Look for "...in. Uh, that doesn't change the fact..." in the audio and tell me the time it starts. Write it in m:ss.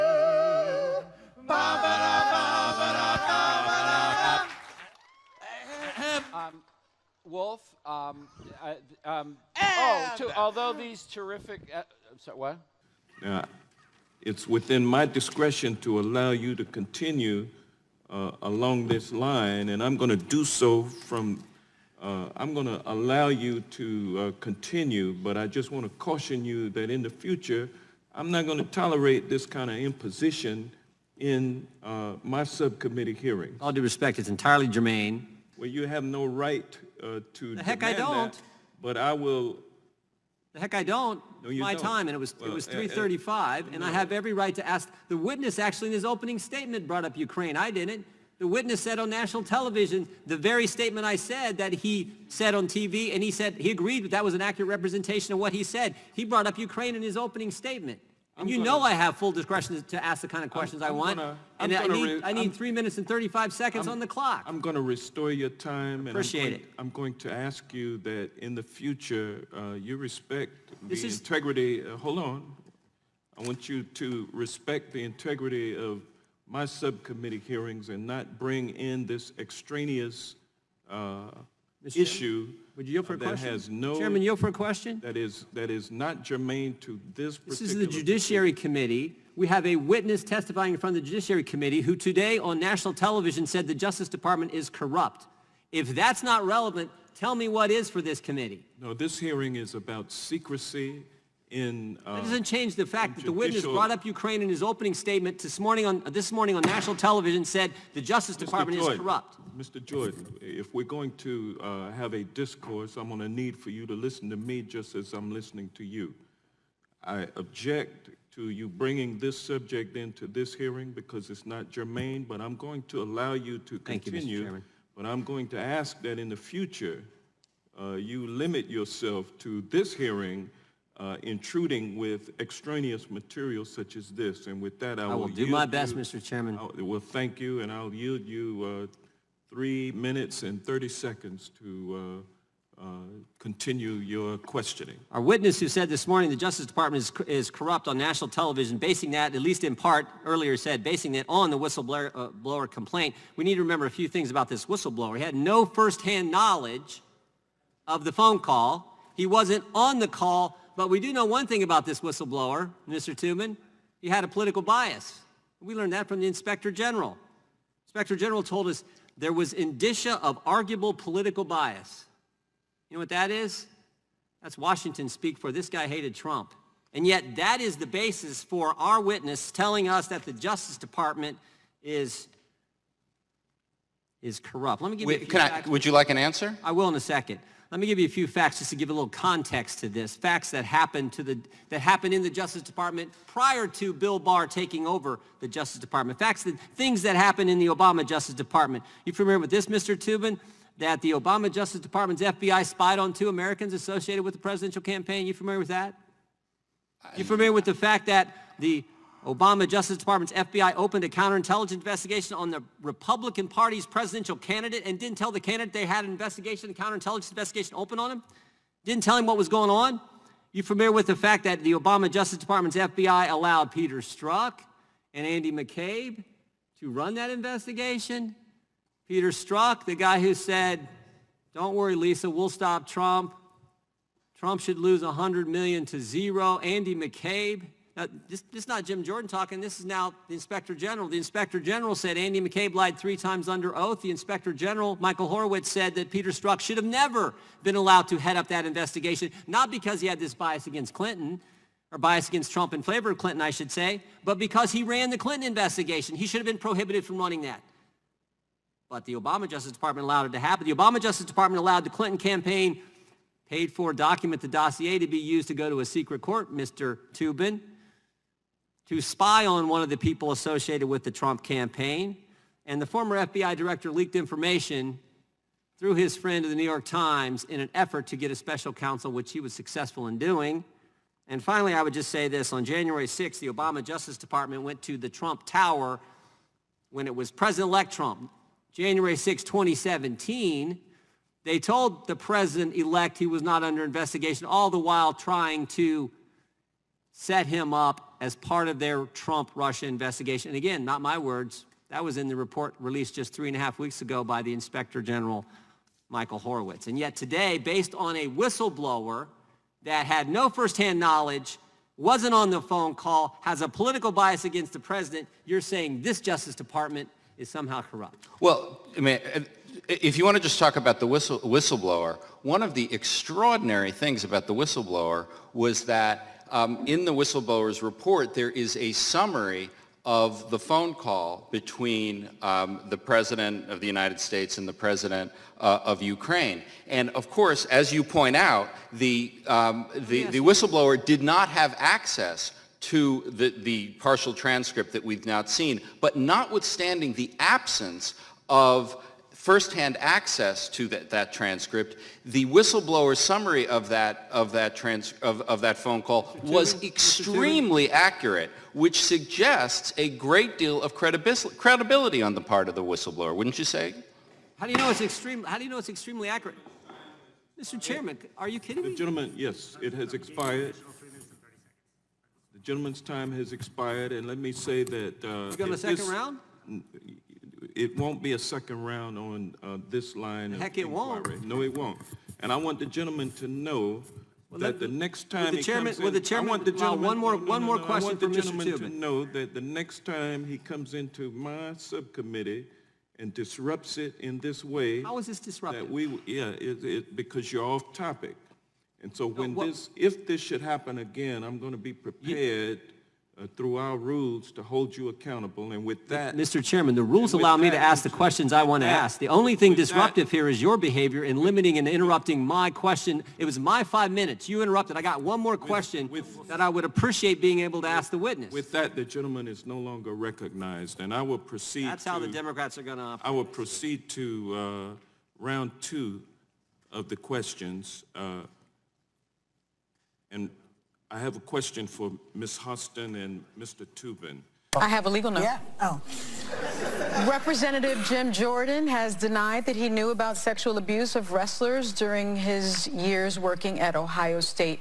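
1:41.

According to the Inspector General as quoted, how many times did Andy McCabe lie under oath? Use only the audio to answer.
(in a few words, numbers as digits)
3.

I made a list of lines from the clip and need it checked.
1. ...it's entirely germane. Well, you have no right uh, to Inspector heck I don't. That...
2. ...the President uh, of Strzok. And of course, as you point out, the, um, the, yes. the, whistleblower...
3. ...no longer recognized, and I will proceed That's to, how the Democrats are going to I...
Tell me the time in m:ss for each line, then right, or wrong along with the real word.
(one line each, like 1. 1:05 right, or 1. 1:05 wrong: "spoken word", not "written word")
1. 0:34 wrong: "The", not "Inspector"
2. 5:34 wrong: "Ukraine", not "Strzok"
3. 6:59 right.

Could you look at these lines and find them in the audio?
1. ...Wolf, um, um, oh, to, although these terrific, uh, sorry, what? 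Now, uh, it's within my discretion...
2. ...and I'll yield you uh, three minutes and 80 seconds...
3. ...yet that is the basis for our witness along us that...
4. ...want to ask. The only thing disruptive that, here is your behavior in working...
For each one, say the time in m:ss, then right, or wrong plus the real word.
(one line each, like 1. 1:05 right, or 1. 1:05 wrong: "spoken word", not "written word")
1. 0:07 right
2. 2:17 wrong: "30", not "80"
3. 2:57 wrong: "telling", not "along"
4. 6:48 wrong: "limiting", not "working".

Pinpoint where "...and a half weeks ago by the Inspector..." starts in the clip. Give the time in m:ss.
5:03.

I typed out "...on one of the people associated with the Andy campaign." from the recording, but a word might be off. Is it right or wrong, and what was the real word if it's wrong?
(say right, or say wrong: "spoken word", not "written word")
wrong: "Trump", not "Andy".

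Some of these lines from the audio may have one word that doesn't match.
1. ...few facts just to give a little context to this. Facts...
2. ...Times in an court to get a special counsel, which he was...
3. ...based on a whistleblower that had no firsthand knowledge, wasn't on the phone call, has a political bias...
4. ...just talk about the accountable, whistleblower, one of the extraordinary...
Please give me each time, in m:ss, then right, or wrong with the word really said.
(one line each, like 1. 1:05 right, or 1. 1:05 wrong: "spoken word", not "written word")
1. 3:08 right
2. 4:36 wrong: "effort", not "court"
3. 5:07 right
4. 5:20 wrong: "whistle", not "accountable".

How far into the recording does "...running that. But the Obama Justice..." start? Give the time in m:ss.
4:17.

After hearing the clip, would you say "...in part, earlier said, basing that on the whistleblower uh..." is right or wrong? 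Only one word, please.
right.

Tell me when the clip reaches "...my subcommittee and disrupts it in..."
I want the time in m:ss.
6:31.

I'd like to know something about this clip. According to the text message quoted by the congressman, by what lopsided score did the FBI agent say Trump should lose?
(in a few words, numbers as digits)
100 million to zero.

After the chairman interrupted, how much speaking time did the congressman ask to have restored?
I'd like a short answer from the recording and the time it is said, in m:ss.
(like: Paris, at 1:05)
3 minutes 35 seconds, at 1:02.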